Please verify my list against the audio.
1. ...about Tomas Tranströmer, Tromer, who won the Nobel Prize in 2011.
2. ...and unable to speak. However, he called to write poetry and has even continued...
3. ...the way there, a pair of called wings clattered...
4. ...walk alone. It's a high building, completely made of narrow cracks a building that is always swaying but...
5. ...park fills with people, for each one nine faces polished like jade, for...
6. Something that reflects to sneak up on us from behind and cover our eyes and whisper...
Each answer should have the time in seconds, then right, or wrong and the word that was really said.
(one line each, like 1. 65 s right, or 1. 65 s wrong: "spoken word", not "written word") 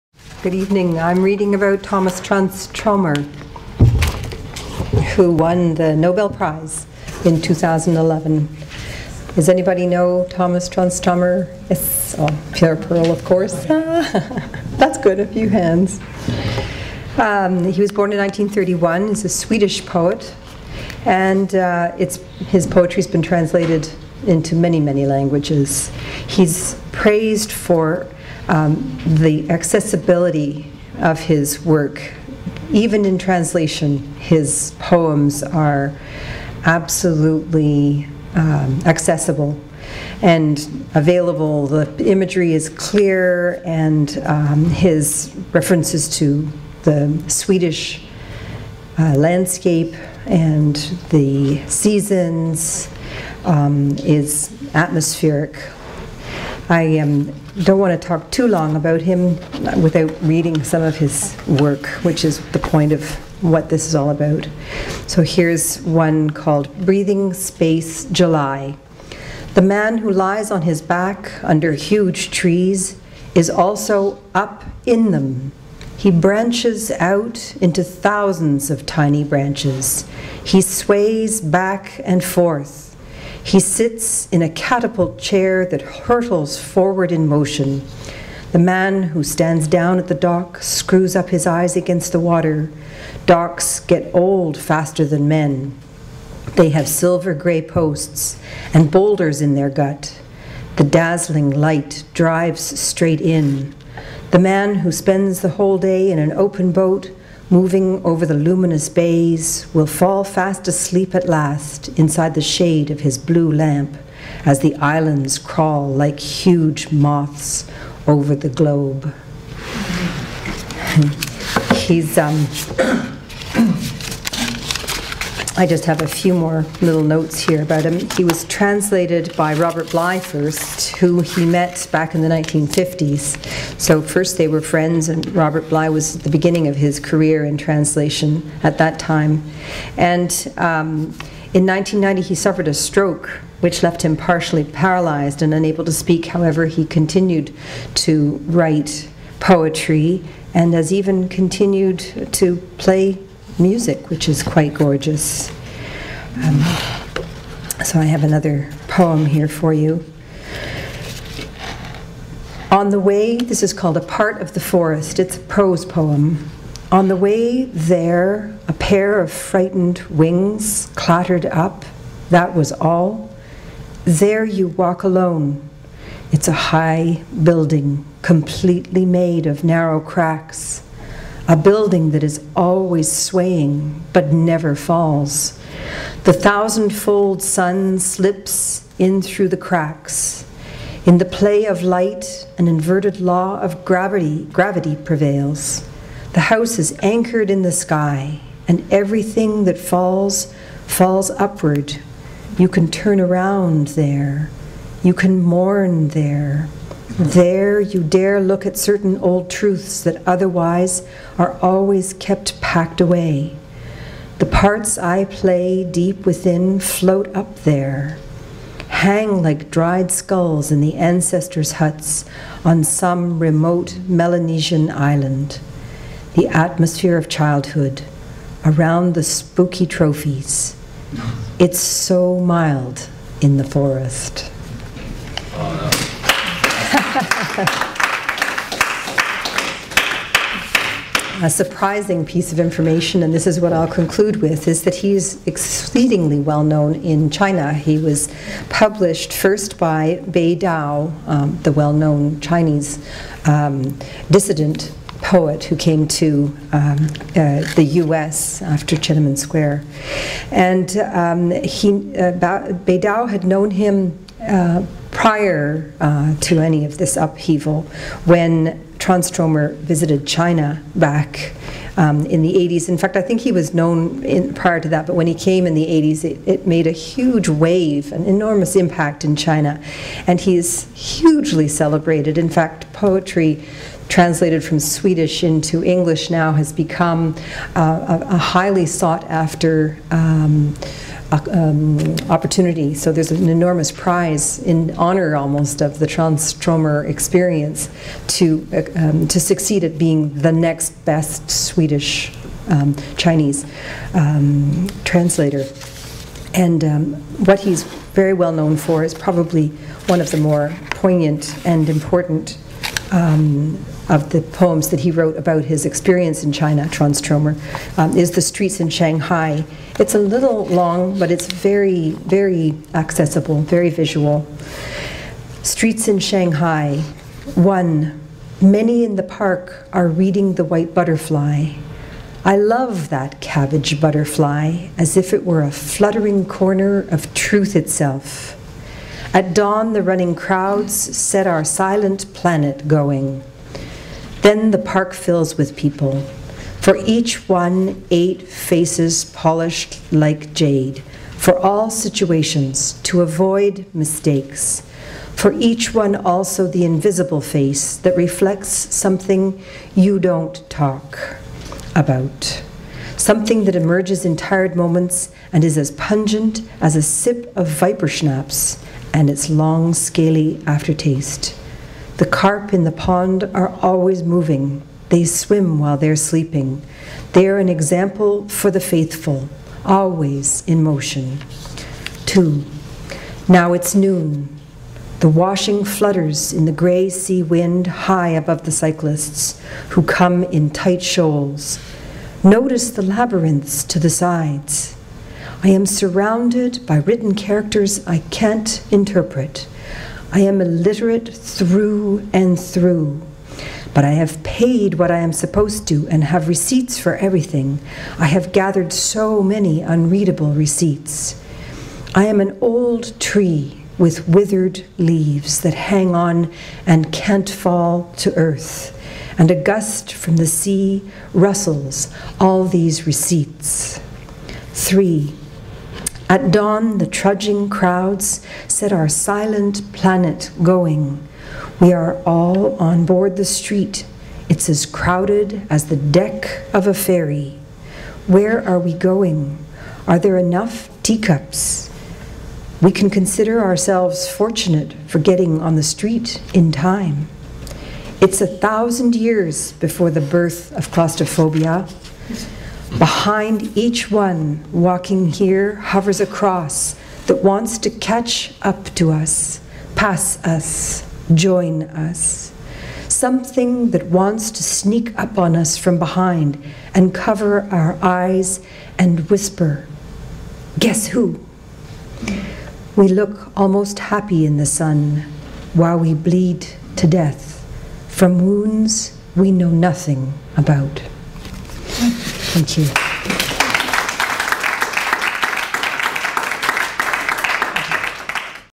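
1. 1 s right
2. 145 s wrong: "continued", not "called"
3. 167 s wrong: "frightened", not "called"
4. 174 s right
5. 344 s wrong: "eight", not "nine"
6. 463 s wrong: "wants", not "reflects".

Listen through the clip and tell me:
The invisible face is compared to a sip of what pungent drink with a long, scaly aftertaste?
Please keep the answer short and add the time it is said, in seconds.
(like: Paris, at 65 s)
viper schnapps, at 367 s.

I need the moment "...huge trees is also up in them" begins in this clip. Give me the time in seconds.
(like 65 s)
71 s.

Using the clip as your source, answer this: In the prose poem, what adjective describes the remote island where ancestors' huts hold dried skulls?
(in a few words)
Melanesian.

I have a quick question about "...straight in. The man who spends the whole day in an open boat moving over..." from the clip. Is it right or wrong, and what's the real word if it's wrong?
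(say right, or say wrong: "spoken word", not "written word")
right.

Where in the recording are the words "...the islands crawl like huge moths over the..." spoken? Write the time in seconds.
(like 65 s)
114 s.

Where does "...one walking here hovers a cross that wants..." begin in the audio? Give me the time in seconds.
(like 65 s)
454 s.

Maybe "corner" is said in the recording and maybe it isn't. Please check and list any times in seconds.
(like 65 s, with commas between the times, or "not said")
336 s.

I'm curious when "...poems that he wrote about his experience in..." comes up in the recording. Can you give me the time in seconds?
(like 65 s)
314 s.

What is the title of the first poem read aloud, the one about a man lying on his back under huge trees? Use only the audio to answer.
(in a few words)
Breathing Space July.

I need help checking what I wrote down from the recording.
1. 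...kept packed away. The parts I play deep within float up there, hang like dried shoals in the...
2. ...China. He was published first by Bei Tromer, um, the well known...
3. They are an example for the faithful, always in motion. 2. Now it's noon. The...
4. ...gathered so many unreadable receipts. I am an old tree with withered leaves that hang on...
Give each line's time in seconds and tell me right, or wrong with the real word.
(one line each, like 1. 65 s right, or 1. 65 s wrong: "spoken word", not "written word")
1. 212 s wrong: "skulls", not "shoals"
2. 247 s wrong: "Dao", not "Tromer"
3. 377 s right
4. 408 s right.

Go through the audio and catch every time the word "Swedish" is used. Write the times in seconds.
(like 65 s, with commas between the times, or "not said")
19 s, 47 s, 284 s, 301 s.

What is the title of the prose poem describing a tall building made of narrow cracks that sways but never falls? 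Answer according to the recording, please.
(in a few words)
A Part of the Forest.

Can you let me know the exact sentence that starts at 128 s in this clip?
He was translated by Robert Bly first, who he met back in the 1950s.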